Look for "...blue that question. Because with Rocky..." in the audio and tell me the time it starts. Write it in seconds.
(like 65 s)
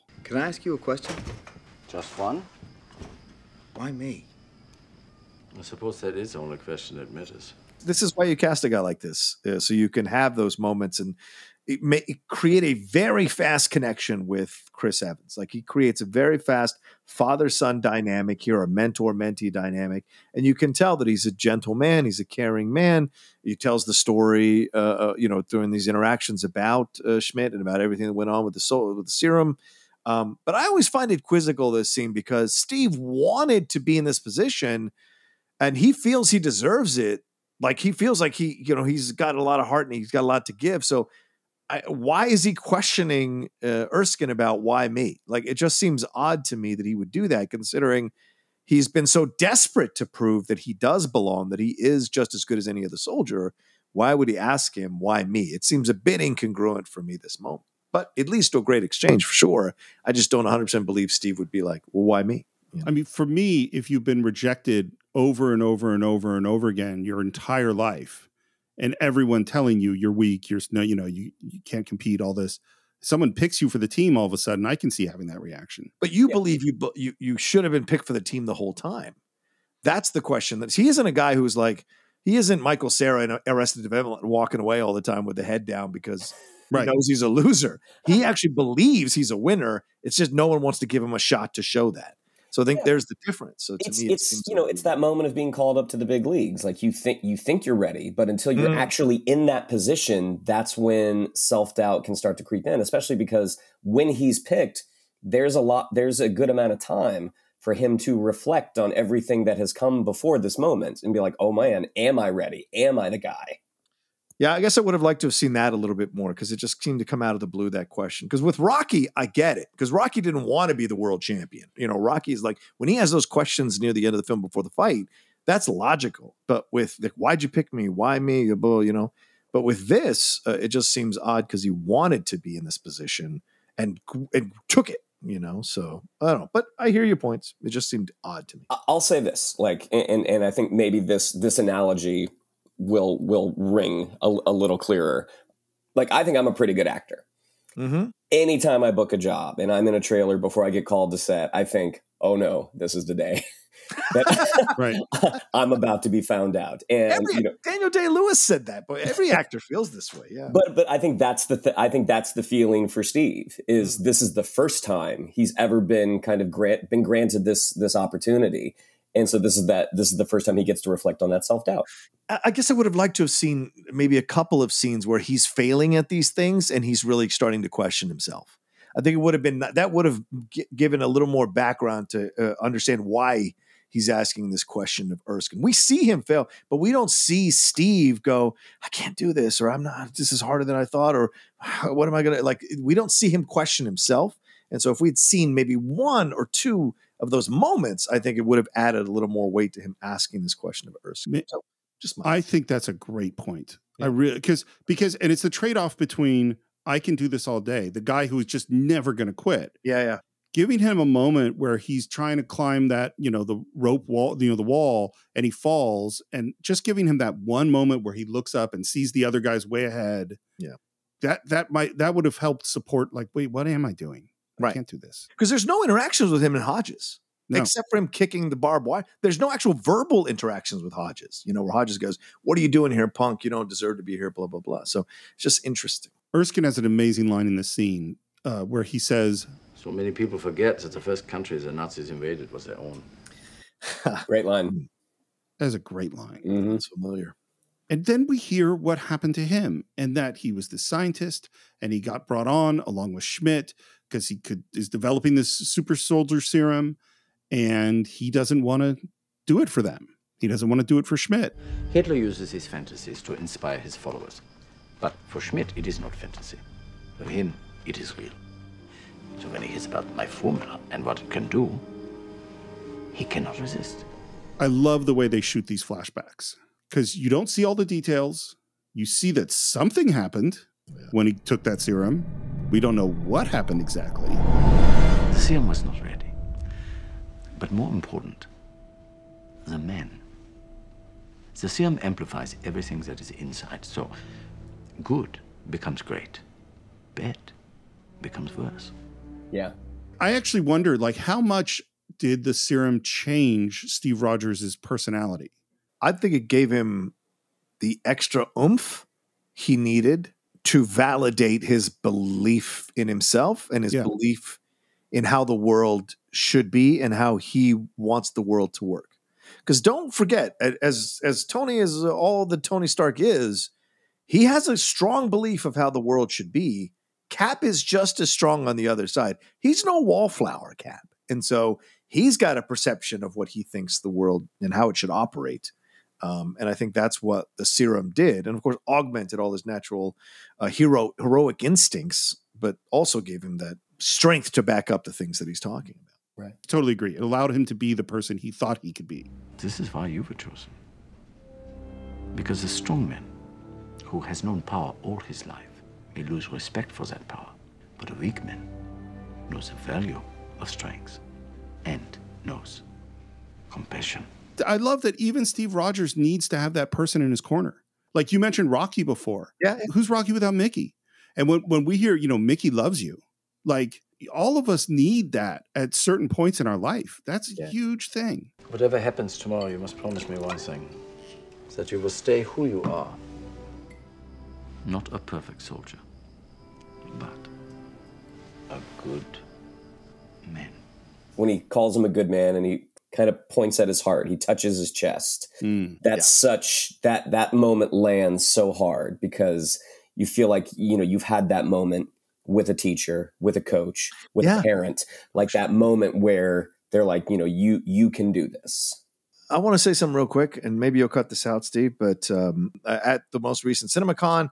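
117 s.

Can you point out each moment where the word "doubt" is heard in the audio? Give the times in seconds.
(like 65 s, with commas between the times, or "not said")
101 s, 171 s.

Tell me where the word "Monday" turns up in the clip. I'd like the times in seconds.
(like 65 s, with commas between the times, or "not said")
not said.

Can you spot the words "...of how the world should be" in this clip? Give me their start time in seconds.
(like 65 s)
325 s.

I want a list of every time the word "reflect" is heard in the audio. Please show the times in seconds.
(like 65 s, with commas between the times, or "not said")
108 s, 170 s.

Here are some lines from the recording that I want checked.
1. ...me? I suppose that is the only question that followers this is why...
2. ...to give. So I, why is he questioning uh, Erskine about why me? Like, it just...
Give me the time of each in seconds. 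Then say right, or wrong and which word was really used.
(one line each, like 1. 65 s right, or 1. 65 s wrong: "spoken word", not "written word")
1. 3 s wrong: "matters", not "followers"
2. 40 s right.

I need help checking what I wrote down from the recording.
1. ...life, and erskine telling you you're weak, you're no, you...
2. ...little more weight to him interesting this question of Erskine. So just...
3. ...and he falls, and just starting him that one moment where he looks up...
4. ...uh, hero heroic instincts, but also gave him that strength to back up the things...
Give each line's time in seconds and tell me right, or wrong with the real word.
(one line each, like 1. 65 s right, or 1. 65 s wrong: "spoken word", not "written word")
1. 67 s wrong: "everyone", not "erskine"
2. 199 s wrong: "asking", not "interesting"
3. 215 s wrong: "giving", not "starting"
4. 340 s right.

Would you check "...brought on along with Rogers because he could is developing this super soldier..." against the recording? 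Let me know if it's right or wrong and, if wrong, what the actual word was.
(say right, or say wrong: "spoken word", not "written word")
wrong: "Schmidt", not "Rogers".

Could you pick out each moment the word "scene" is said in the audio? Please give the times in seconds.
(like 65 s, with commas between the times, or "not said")
31 s, 174 s, 237 s.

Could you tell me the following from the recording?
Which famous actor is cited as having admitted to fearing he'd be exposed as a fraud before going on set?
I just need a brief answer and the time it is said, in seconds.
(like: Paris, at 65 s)
Daniel Day Lewis, at 157 s.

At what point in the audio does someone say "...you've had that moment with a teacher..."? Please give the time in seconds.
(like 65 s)
401 s.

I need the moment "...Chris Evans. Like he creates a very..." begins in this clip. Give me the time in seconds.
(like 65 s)
14 s.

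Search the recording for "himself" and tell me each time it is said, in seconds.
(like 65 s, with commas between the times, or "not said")
178 s, 193 s, 313 s.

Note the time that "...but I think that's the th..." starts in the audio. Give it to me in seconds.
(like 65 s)
160 s.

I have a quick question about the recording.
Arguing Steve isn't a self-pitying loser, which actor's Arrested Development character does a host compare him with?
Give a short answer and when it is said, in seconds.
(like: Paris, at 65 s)
Michael Cera, at 82 s.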